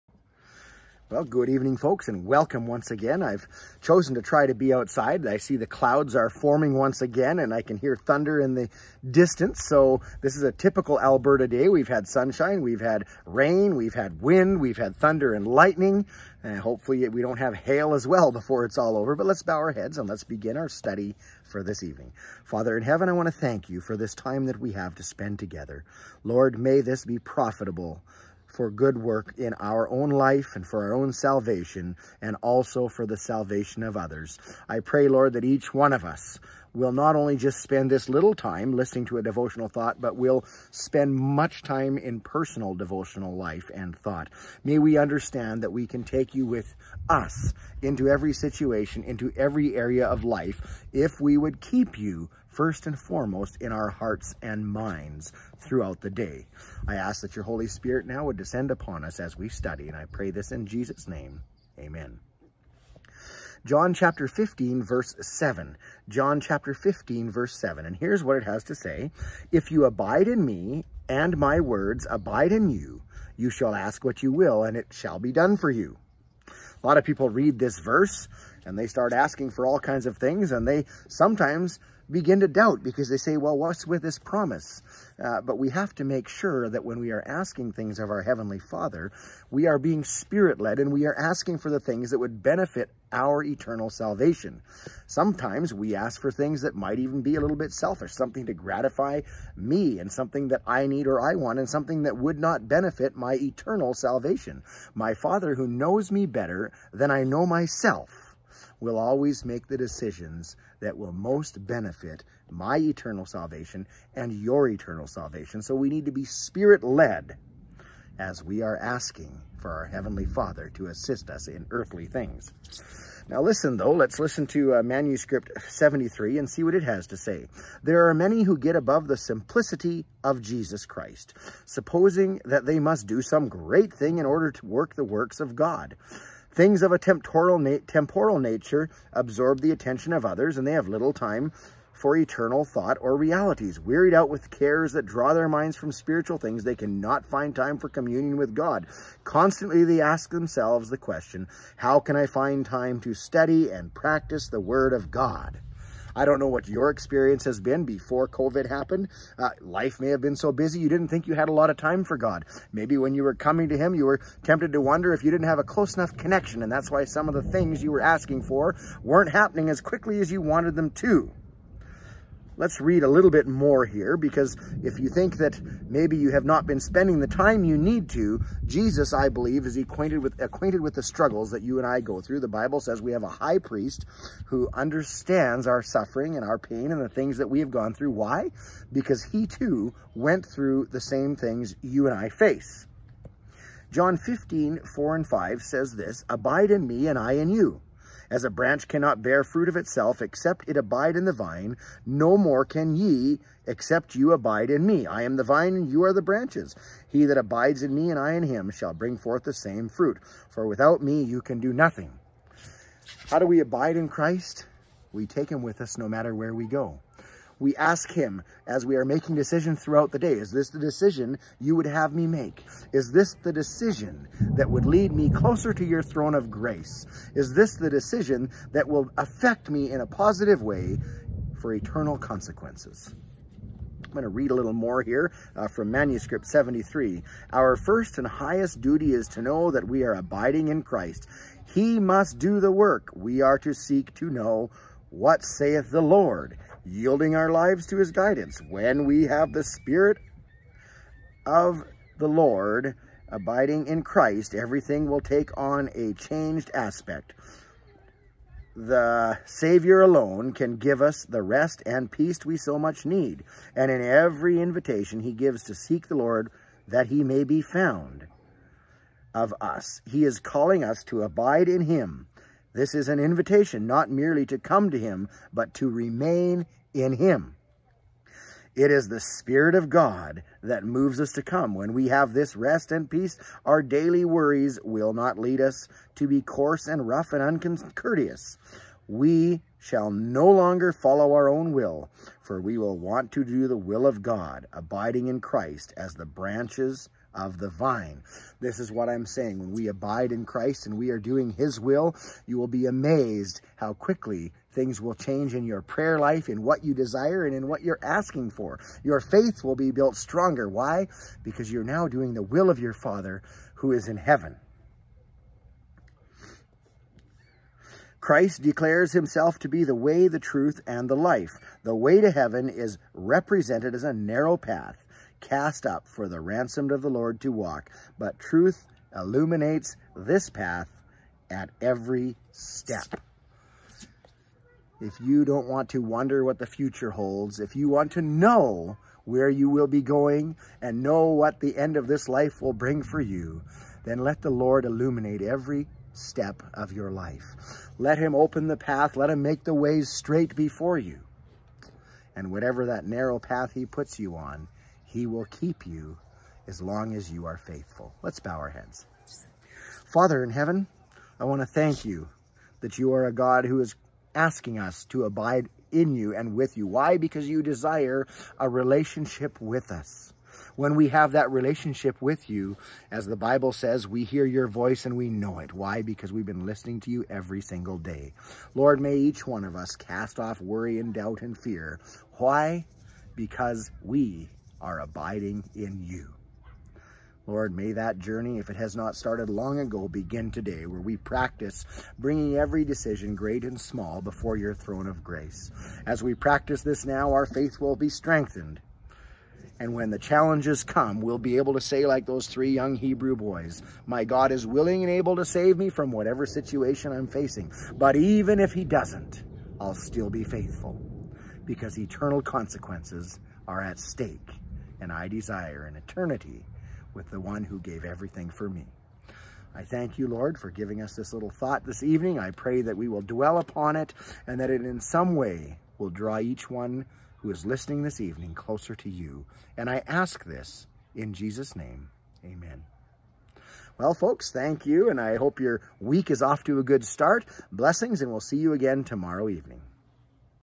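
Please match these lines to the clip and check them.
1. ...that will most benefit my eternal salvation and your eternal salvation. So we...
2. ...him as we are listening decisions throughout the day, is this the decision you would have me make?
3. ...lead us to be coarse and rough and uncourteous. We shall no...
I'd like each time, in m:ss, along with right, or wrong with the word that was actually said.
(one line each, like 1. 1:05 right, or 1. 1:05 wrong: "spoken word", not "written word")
1. 1:50 right
2. 3:38 wrong: "making", not "listening"
3. 4:45 right.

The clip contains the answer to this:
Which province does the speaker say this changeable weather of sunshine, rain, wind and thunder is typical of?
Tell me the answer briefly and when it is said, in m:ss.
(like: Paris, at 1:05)
Alberta, at 0:11.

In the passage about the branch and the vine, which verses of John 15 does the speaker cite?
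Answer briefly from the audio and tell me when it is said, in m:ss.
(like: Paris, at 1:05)
4 and 5, at 3:14.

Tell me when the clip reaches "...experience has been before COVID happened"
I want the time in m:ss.
2:36.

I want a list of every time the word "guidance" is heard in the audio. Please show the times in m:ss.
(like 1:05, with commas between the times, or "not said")
4:08.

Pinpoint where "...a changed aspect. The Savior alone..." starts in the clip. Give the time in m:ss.
4:15.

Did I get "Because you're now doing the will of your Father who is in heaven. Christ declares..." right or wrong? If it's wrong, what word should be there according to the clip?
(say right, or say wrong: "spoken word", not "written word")
right.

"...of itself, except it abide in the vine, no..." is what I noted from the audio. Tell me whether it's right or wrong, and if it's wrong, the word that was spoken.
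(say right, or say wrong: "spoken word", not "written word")
right.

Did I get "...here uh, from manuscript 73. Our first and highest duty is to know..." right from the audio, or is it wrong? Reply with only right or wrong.
right.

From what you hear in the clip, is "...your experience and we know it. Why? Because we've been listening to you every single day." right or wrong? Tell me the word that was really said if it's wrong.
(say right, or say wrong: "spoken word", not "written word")
wrong: "voice", not "experience".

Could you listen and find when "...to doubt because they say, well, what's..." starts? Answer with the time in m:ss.
1:22.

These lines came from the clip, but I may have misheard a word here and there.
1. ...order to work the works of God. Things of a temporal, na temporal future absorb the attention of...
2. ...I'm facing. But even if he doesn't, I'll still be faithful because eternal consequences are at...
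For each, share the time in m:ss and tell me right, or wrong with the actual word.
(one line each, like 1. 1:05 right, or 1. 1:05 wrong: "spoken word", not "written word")
1. 2:14 wrong: "nature", not "future"
2. 6:47 right.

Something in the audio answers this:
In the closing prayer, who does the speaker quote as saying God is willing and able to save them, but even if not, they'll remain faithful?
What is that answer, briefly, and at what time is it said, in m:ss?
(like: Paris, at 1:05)
three young Hebrew boys, at 6:42.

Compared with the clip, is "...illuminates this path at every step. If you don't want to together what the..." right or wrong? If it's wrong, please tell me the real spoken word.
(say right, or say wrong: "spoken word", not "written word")
wrong: "wonder", not "together".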